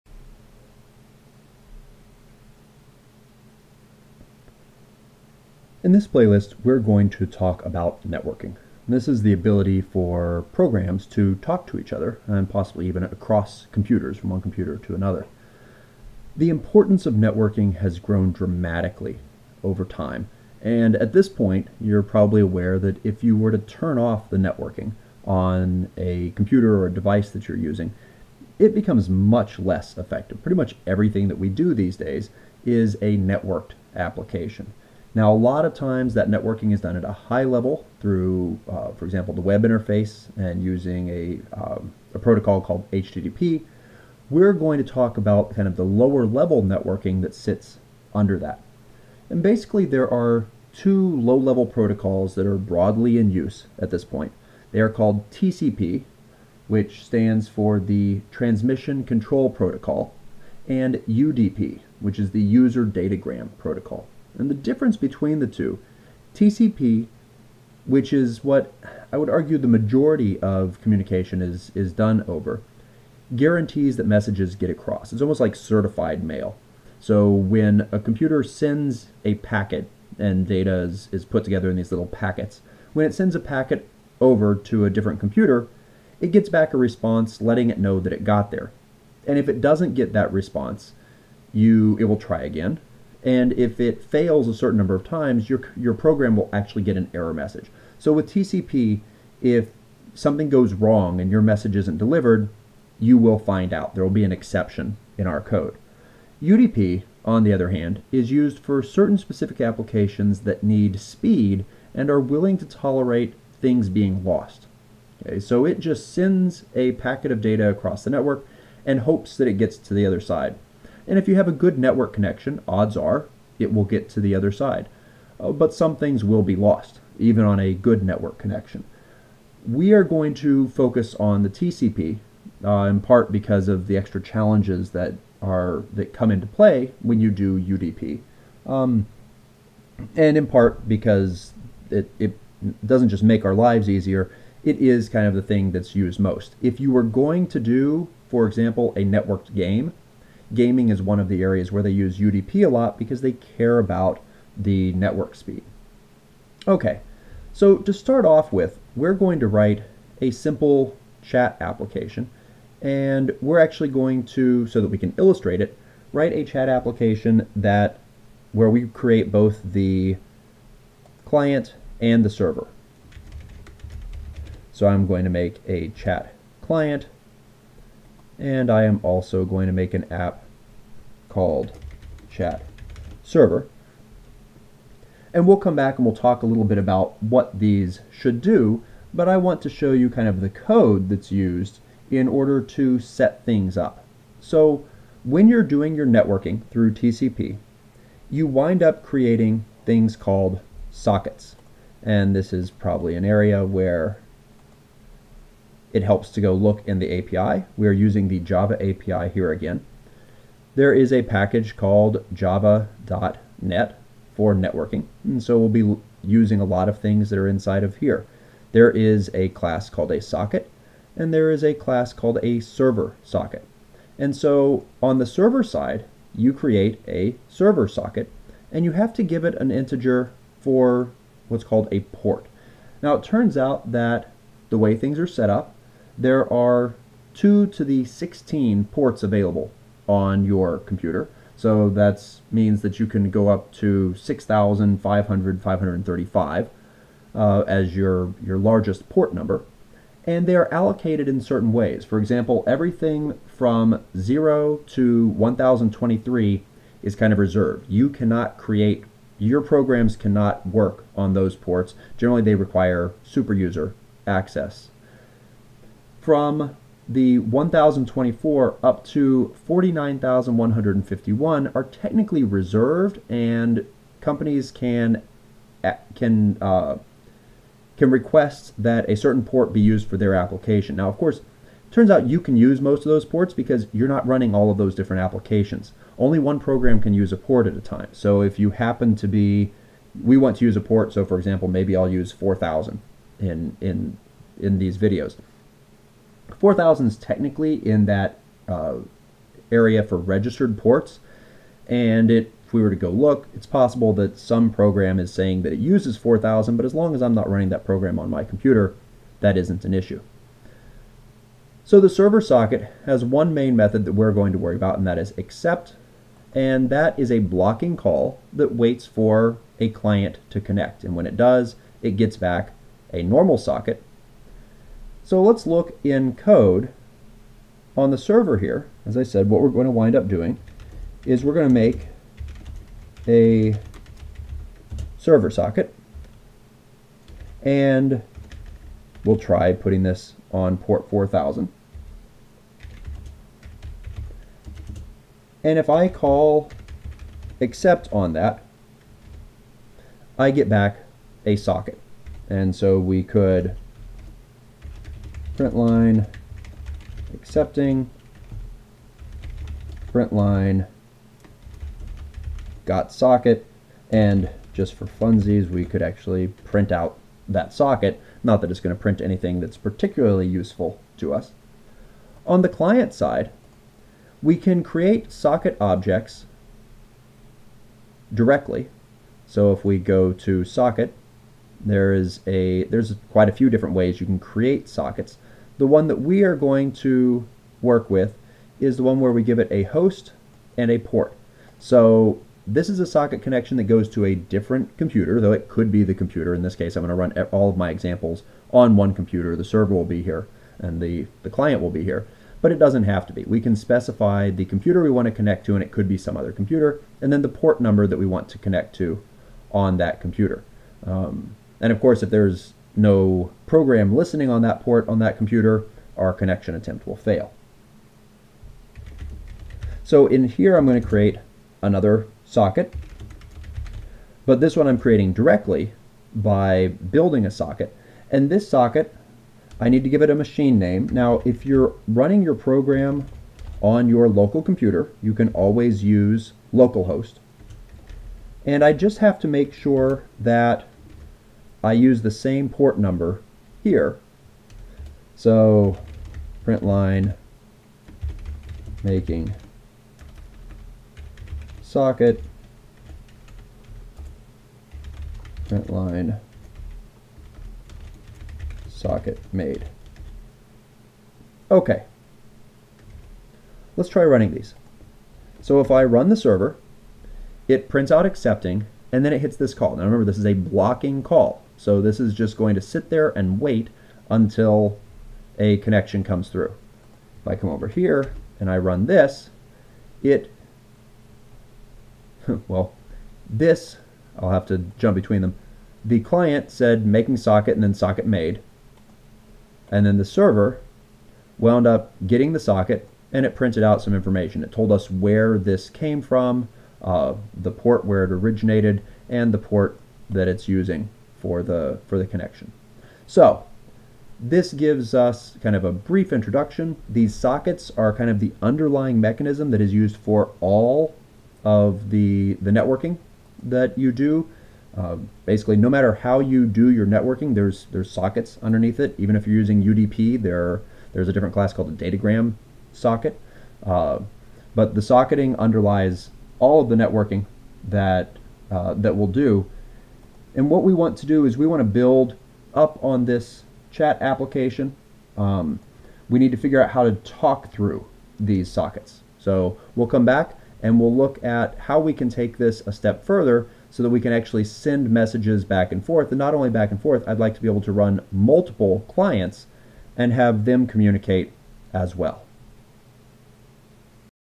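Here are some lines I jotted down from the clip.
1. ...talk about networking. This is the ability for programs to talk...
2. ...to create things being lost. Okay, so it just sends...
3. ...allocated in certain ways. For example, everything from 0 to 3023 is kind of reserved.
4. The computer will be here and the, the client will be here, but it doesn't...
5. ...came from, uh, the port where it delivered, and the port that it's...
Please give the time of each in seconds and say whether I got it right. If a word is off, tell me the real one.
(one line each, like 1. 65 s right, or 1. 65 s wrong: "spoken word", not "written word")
1. 7 s right
2. 112 s wrong: "tolerate", not "create"
3. 250 s wrong: "1023", not "3023"
4. 399 s wrong: "server", not "computer"
5. 495 s wrong: "originated", not "delivered".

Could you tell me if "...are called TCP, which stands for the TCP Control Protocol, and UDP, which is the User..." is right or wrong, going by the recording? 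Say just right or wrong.
wrong.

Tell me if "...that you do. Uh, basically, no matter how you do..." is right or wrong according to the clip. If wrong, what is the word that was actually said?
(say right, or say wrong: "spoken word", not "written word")
right.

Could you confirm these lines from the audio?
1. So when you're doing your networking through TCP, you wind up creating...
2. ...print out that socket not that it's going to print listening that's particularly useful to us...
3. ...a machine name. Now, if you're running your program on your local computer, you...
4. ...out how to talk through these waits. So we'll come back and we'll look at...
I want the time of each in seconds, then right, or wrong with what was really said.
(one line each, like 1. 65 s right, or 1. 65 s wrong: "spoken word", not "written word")
1. 194 s right
2. 366 s wrong: "anything", not "listening"
3. 430 s right
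4. 536 s wrong: "sockets", not "waits".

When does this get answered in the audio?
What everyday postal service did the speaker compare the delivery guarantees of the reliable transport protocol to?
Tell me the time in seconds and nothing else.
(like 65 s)
75 s.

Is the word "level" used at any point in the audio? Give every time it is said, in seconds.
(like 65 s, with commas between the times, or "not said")
37 s, 46 s, 51 s.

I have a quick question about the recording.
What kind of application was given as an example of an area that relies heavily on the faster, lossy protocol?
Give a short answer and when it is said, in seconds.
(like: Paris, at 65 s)
A networked game, at 149 s.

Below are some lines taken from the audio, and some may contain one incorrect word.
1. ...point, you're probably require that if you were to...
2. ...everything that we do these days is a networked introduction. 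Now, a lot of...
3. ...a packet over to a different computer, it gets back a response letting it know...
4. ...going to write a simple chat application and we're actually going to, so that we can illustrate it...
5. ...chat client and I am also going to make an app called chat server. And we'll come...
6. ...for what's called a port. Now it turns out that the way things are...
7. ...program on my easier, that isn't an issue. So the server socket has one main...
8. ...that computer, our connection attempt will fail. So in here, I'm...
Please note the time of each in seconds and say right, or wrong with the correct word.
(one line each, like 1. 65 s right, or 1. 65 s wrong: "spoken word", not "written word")
1. 21 s wrong: "aware", not "require"
2. 30 s wrong: "application", not "introduction"
3. 83 s right
4. 159 s right
5. 175 s right
6. 230 s right
7. 307 s wrong: "computer", not "easier"
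8. 415 s right.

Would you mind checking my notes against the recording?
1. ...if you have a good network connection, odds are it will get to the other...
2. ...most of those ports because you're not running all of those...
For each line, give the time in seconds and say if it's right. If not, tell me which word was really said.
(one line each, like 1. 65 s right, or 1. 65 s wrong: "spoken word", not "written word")
1. 121 s right
2. 282 s right.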